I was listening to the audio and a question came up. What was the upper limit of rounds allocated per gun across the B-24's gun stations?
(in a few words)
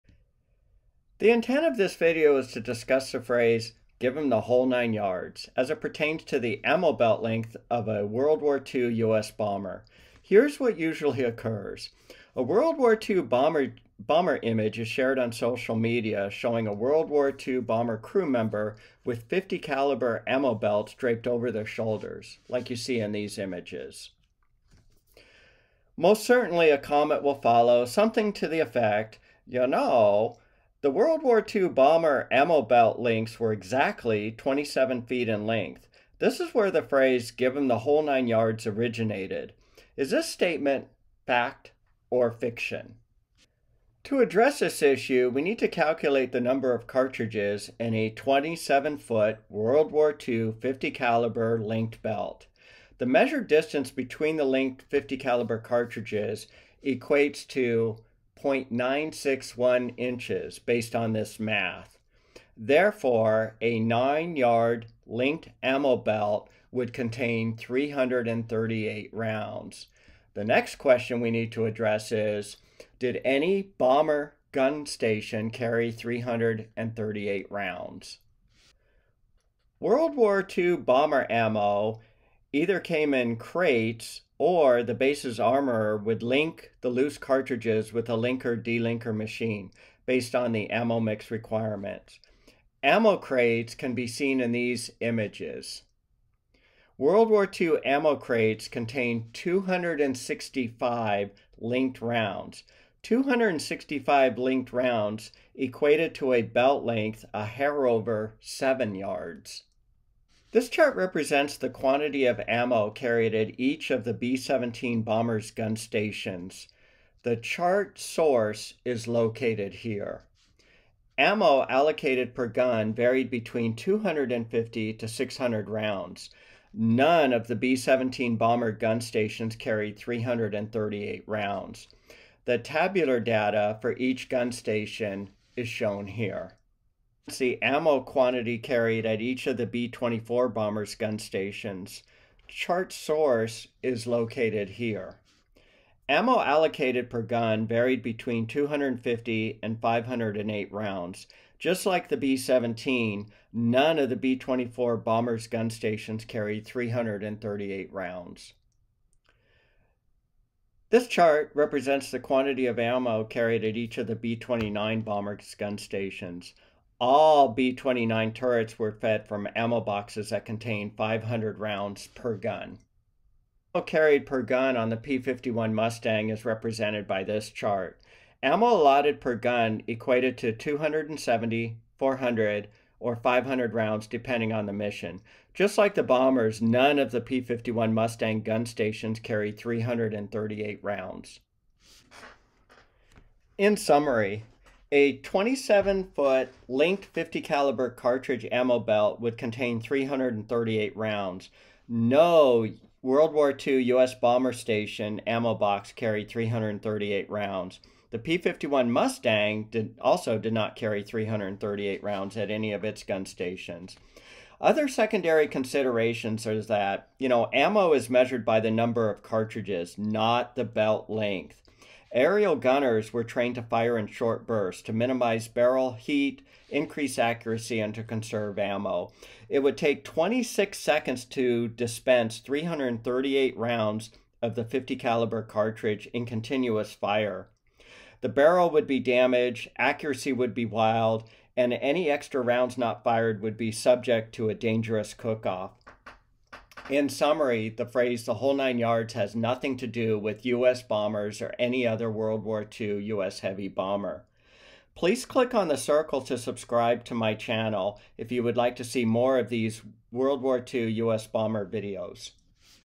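508.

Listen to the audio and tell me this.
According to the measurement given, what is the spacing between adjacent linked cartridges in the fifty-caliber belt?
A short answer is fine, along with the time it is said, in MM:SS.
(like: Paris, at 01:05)
0.961 inches, at 00:58.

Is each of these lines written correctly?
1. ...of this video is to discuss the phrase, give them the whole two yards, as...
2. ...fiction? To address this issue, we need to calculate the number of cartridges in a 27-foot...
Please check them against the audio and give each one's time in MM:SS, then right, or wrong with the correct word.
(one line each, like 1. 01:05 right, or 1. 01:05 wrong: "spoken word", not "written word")
1. 00:01 wrong: "nine", not "two"
2. 00:42 right.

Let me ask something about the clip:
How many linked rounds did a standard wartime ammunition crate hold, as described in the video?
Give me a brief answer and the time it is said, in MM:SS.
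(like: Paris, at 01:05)
265, at 01:36.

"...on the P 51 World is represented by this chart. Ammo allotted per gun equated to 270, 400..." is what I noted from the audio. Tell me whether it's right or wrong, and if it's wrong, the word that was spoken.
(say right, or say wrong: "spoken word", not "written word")
wrong: "Mustang", not "World".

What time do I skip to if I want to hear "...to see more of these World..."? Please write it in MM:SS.
04:18.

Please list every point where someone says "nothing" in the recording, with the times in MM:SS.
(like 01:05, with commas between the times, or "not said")
04:09.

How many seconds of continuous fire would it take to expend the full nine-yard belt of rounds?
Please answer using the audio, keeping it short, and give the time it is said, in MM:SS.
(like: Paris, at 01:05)
26 seconds, at 03:50.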